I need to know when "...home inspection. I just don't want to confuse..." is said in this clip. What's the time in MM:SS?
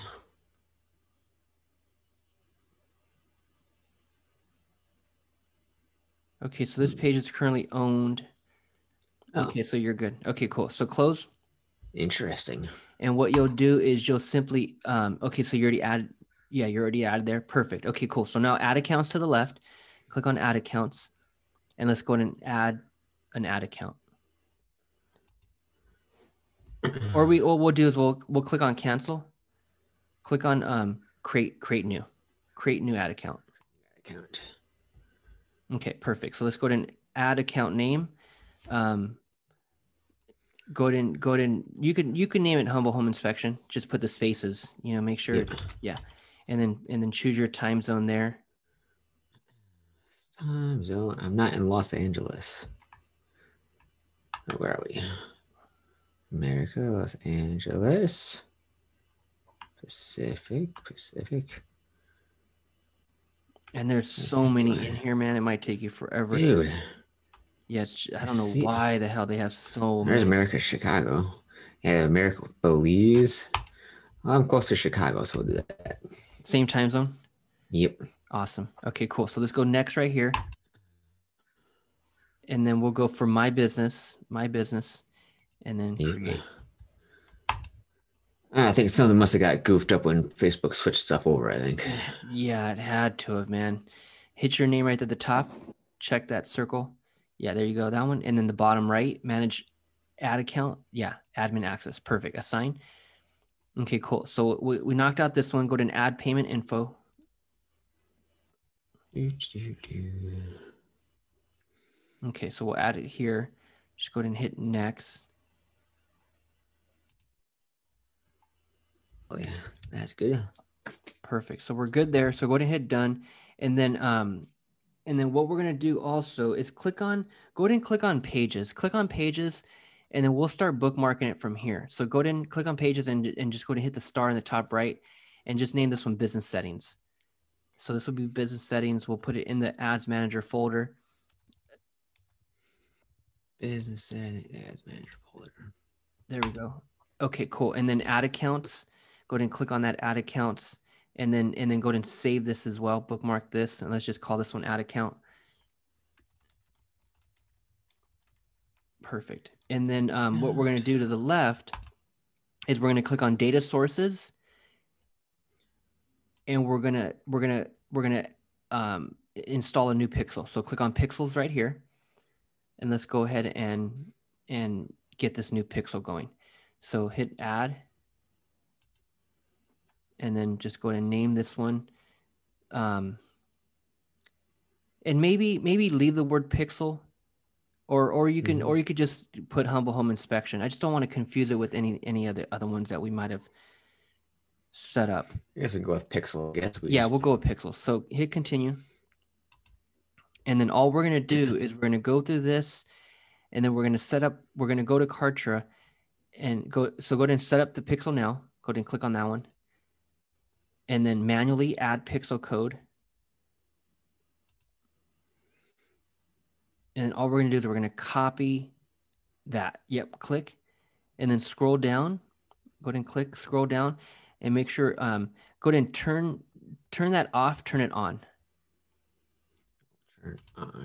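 03:09.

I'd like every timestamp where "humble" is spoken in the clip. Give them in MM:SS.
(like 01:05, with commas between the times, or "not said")
00:42, 03:09.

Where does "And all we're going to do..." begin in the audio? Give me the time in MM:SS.
03:36.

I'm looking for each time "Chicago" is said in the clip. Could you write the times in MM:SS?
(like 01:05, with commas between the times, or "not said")
01:10, 01:14.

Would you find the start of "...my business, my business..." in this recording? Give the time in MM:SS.
01:23.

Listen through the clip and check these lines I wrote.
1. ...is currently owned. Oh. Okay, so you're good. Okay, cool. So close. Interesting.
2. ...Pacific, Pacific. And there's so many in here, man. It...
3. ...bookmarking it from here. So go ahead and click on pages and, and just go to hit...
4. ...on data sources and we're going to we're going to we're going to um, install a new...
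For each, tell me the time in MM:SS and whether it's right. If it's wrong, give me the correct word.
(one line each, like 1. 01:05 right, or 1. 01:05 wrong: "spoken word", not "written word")
1. 00:07 right
2. 00:59 right
3. 02:10 right
4. 02:43 right.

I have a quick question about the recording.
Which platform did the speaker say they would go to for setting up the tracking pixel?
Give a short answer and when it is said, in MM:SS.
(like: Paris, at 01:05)
Kartra, at 03:25.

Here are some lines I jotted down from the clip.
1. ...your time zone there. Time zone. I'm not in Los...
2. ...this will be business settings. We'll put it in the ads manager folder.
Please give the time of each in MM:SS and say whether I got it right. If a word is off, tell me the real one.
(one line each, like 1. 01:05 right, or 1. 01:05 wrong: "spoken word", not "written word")
1. 00:47 right
2. 02:17 right.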